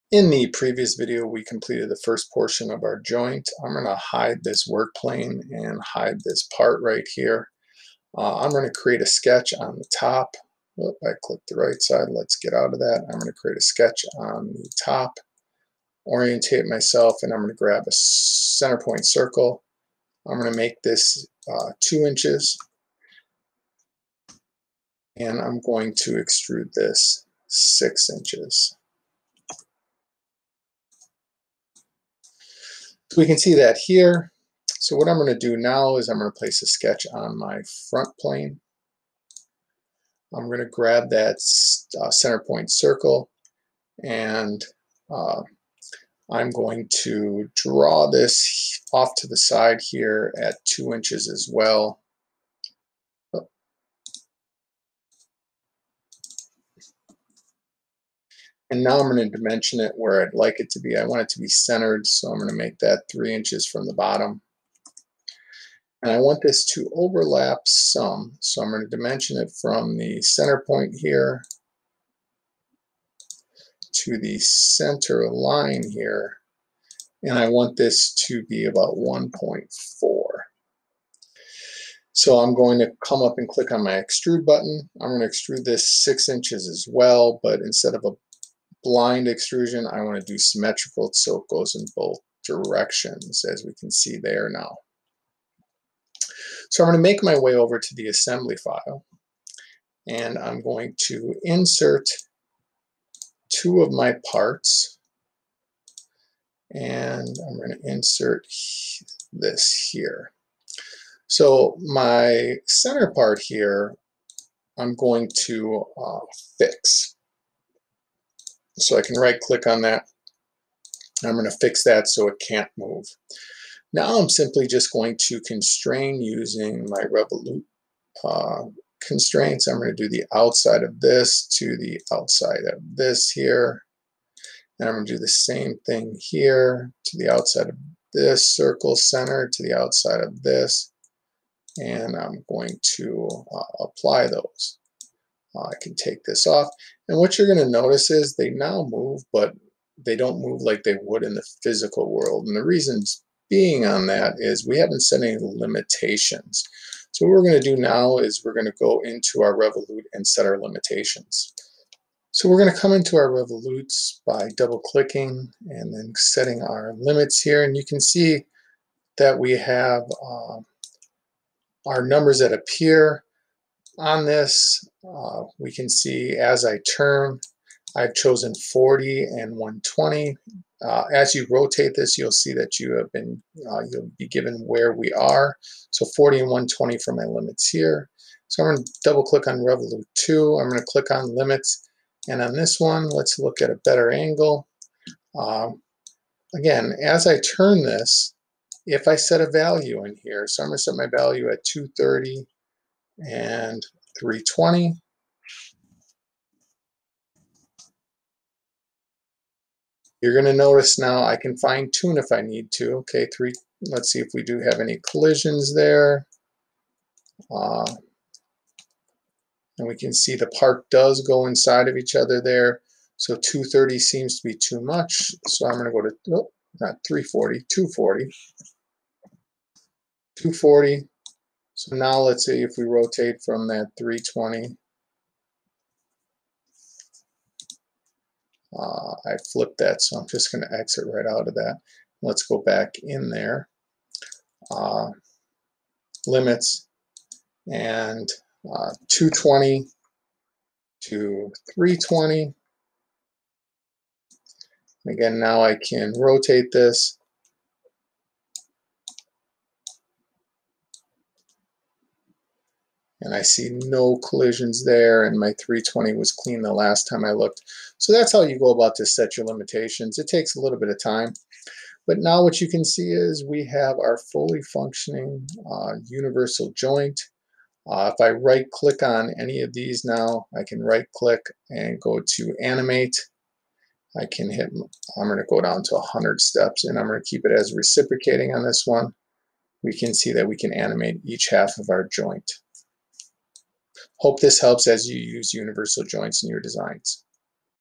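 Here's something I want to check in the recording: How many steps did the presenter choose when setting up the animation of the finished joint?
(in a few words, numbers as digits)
100.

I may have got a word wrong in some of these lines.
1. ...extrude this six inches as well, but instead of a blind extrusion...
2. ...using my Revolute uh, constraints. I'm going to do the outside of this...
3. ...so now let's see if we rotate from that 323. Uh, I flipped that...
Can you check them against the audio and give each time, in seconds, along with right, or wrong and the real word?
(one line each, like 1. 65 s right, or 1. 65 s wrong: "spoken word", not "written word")
1. 85 s right
2. 126 s right
3. 231 s wrong: "320", not "323".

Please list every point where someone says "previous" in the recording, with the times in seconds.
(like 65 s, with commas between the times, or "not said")
0 s.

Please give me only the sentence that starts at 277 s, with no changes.
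Uh, if I right click on any of these now, I can right click and go to animate.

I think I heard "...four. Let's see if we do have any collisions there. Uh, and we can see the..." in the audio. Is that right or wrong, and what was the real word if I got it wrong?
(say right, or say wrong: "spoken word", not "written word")
wrong: "three", not "four".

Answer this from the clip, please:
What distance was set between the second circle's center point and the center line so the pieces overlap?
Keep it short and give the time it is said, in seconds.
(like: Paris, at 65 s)
1.4, at 78 s.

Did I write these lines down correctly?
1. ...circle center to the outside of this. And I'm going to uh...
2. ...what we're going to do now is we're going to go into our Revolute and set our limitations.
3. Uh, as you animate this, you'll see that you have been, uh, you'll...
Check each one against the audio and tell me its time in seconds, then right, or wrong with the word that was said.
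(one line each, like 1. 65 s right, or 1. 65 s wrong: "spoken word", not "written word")
1. 138 s right
2. 157 s right
3. 180 s wrong: "rotate", not "animate".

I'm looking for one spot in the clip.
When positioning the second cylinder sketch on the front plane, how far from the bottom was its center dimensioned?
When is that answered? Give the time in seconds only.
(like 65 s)
63 s.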